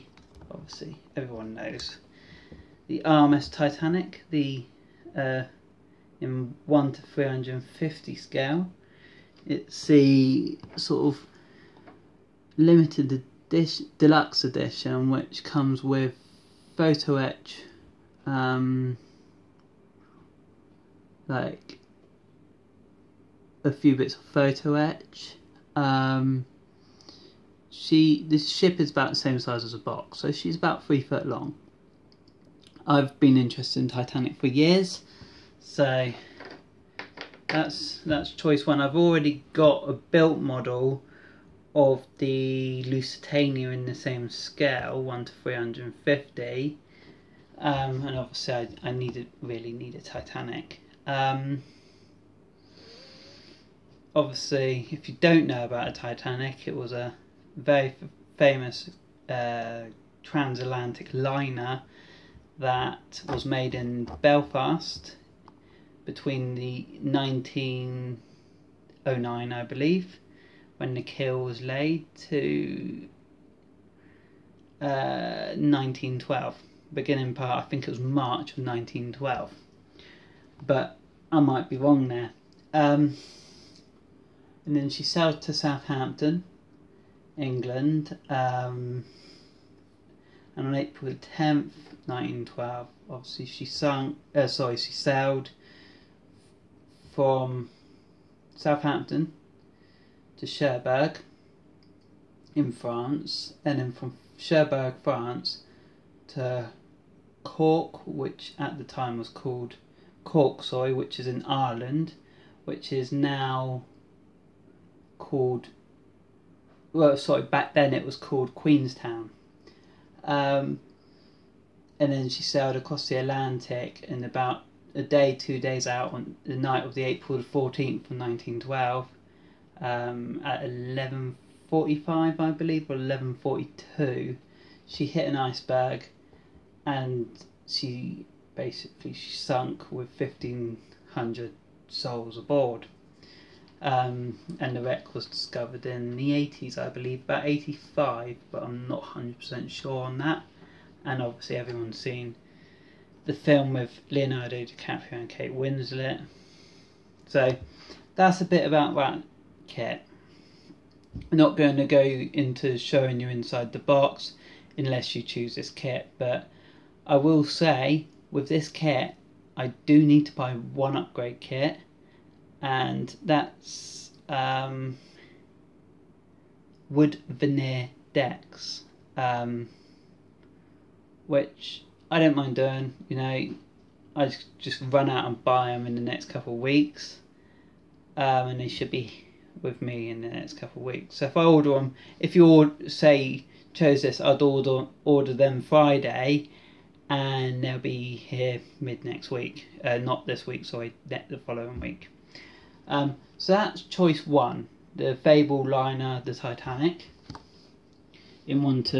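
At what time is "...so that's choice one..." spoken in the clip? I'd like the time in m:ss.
3:23.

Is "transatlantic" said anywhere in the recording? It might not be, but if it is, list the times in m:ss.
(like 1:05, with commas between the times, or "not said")
1:00.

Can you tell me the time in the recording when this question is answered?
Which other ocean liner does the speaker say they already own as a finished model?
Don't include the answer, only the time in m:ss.
0:42.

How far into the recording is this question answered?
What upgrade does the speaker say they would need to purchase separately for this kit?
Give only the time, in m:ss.
2:56.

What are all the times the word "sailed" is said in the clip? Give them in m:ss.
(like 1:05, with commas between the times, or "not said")
1:25, 1:34, 2:02.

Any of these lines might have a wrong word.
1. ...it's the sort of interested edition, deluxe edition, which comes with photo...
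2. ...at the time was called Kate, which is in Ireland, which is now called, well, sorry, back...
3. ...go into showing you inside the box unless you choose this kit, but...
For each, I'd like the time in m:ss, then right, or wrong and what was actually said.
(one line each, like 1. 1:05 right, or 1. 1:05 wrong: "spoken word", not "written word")
1. 0:09 wrong: "limited", not "interested"
2. 1:48 wrong: "Corksoy", not "Kate"
3. 2:41 right.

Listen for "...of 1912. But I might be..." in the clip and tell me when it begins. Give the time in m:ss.
1:18.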